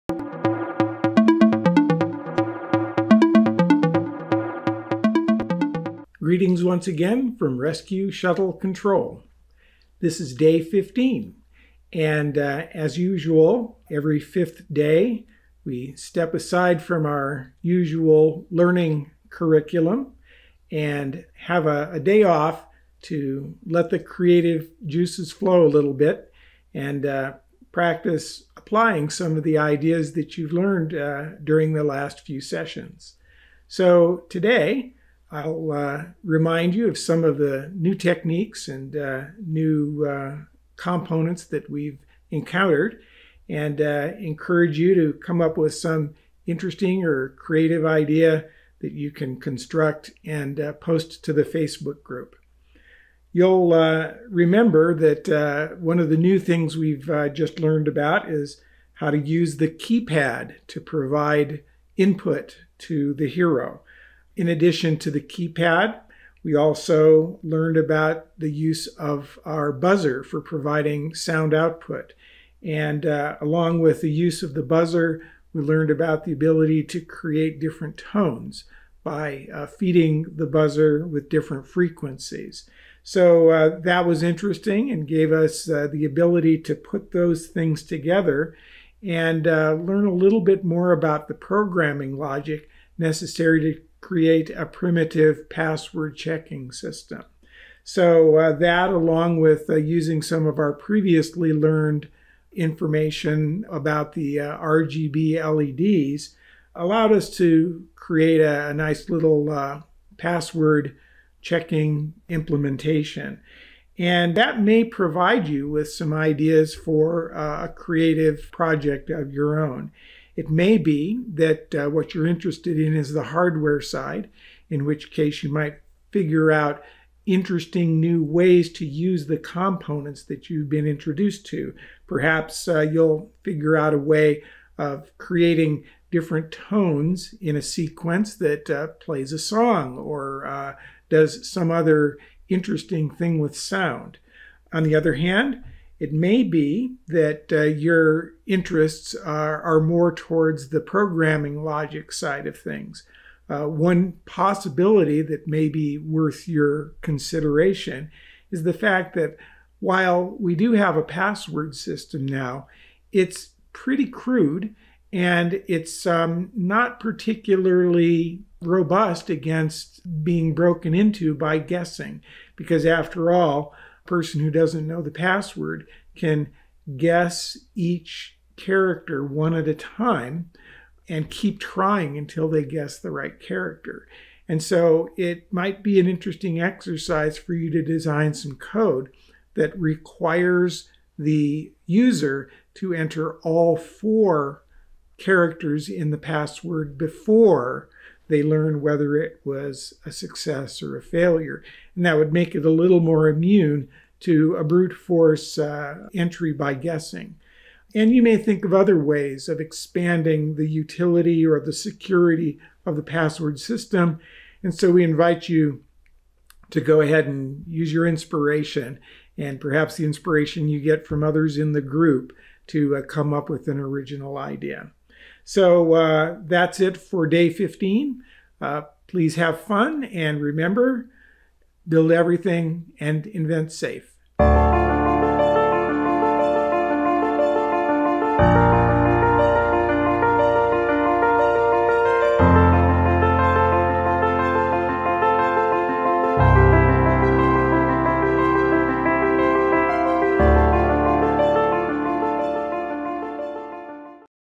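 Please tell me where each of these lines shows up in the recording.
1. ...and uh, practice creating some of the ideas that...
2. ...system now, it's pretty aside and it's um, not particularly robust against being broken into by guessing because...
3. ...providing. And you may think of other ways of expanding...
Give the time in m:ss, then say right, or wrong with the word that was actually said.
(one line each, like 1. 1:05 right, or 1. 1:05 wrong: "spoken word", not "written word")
1. 0:26 wrong: "applying", not "creating"
2. 2:41 wrong: "crude", not "aside"
3. 3:26 wrong: "guessing", not "providing".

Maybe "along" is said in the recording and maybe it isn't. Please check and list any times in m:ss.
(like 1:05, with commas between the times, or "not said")
1:13, 1:38.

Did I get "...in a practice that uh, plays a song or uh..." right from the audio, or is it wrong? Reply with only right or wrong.
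wrong.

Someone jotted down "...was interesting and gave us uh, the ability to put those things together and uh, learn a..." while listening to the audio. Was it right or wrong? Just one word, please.
right.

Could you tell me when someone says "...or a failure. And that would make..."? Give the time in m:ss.
3:20.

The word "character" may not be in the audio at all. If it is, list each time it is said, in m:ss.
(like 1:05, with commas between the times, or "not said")
2:58, 3:03, 3:15.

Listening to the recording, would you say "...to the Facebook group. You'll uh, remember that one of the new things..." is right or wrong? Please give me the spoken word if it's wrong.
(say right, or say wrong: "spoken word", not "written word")
right.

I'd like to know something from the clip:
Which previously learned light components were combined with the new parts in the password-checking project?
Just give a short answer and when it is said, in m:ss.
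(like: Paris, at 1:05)
RGB LEDs, at 1:44.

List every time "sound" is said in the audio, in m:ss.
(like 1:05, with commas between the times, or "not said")
1:11, 2:23.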